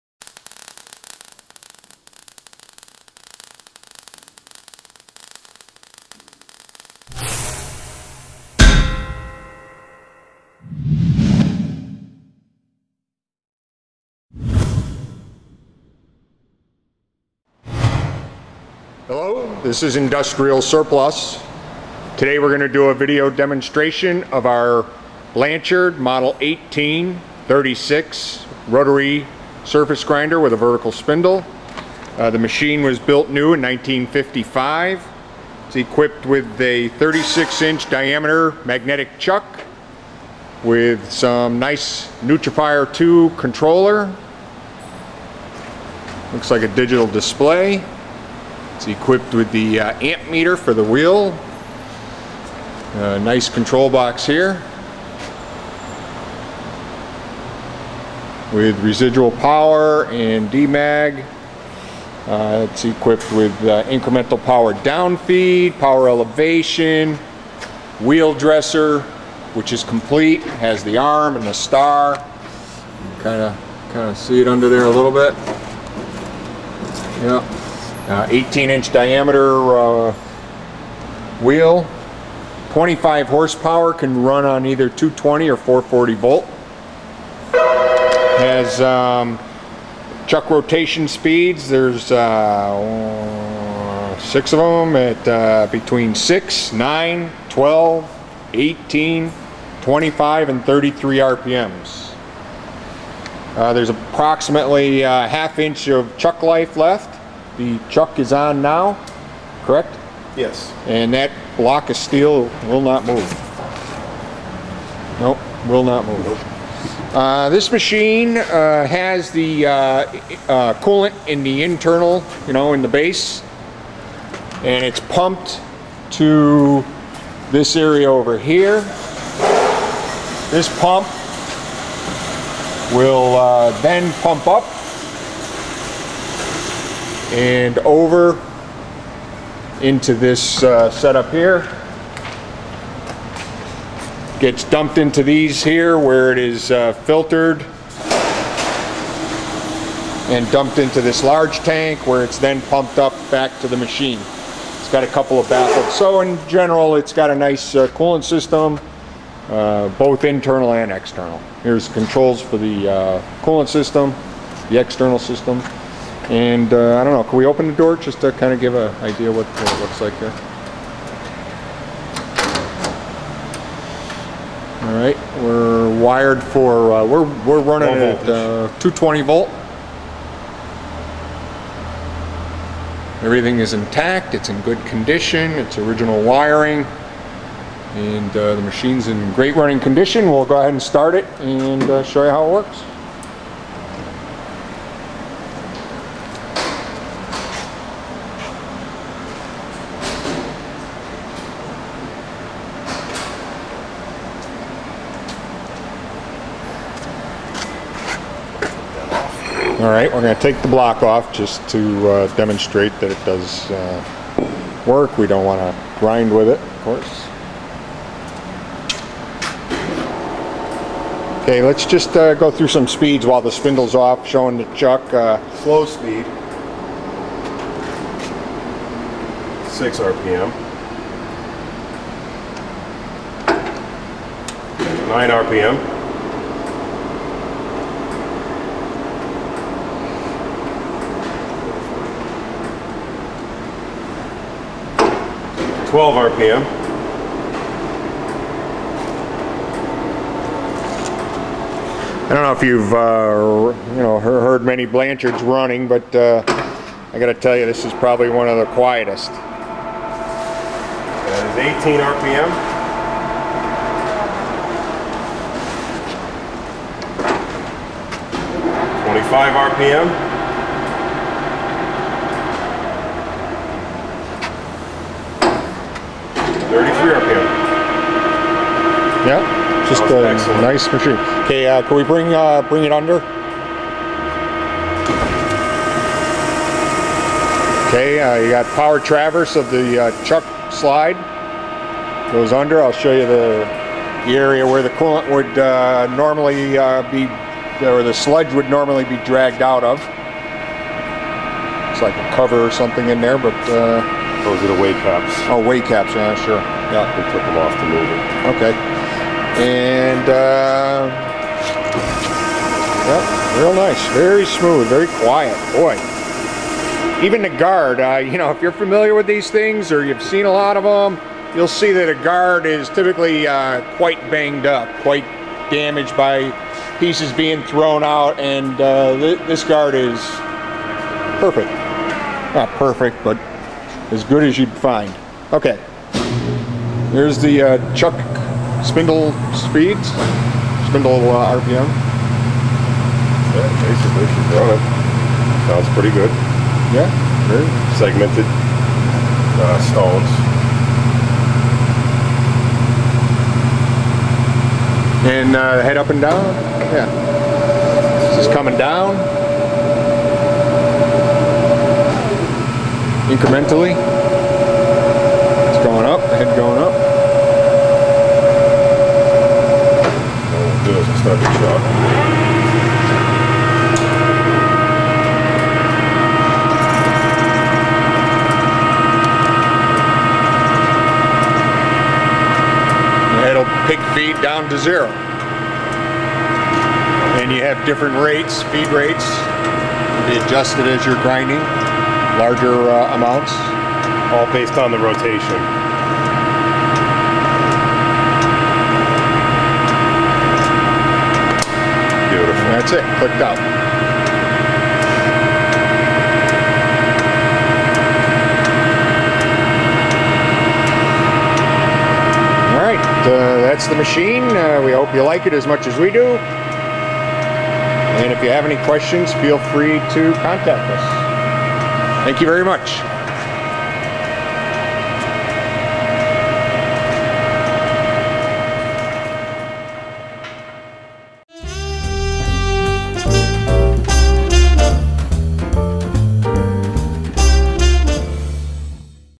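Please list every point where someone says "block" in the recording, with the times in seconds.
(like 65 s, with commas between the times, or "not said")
111 s, 210 s.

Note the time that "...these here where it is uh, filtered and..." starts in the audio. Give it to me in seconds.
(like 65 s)
145 s.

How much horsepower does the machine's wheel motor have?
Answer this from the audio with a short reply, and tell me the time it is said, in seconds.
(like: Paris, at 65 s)
25 horsepower, at 82 s.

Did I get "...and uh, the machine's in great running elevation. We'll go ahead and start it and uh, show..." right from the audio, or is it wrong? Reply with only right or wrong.
wrong.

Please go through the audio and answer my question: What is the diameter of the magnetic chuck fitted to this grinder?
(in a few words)
36 inch.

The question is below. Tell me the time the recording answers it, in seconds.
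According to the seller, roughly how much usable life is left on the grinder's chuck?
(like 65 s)
105 s.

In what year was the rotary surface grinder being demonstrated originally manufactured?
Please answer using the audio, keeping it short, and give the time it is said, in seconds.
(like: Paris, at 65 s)
1955, at 33 s.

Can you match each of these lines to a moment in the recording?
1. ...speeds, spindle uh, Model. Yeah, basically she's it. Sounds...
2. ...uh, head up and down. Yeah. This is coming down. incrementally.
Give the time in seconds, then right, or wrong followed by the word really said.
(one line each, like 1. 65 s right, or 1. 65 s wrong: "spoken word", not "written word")
1. 339 s wrong: "RPM", not "Model"
2. 355 s right.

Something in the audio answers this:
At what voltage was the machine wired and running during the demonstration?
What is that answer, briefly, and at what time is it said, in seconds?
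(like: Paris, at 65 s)
220 volt, at 178 s.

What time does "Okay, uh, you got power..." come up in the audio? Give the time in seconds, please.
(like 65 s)
287 s.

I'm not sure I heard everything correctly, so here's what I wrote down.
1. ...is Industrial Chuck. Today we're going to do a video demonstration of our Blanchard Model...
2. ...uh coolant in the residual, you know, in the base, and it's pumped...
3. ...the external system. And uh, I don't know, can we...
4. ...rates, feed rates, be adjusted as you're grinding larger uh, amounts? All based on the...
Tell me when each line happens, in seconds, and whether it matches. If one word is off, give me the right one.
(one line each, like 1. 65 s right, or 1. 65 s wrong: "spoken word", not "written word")
1. 19 s wrong: "Surplus", not "Chuck"
2. 119 s wrong: "internal", not "residual"
3. 164 s right
4. 388 s right.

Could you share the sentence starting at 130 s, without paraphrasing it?
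This pump will uh, then pump up and over into this uh, setup here.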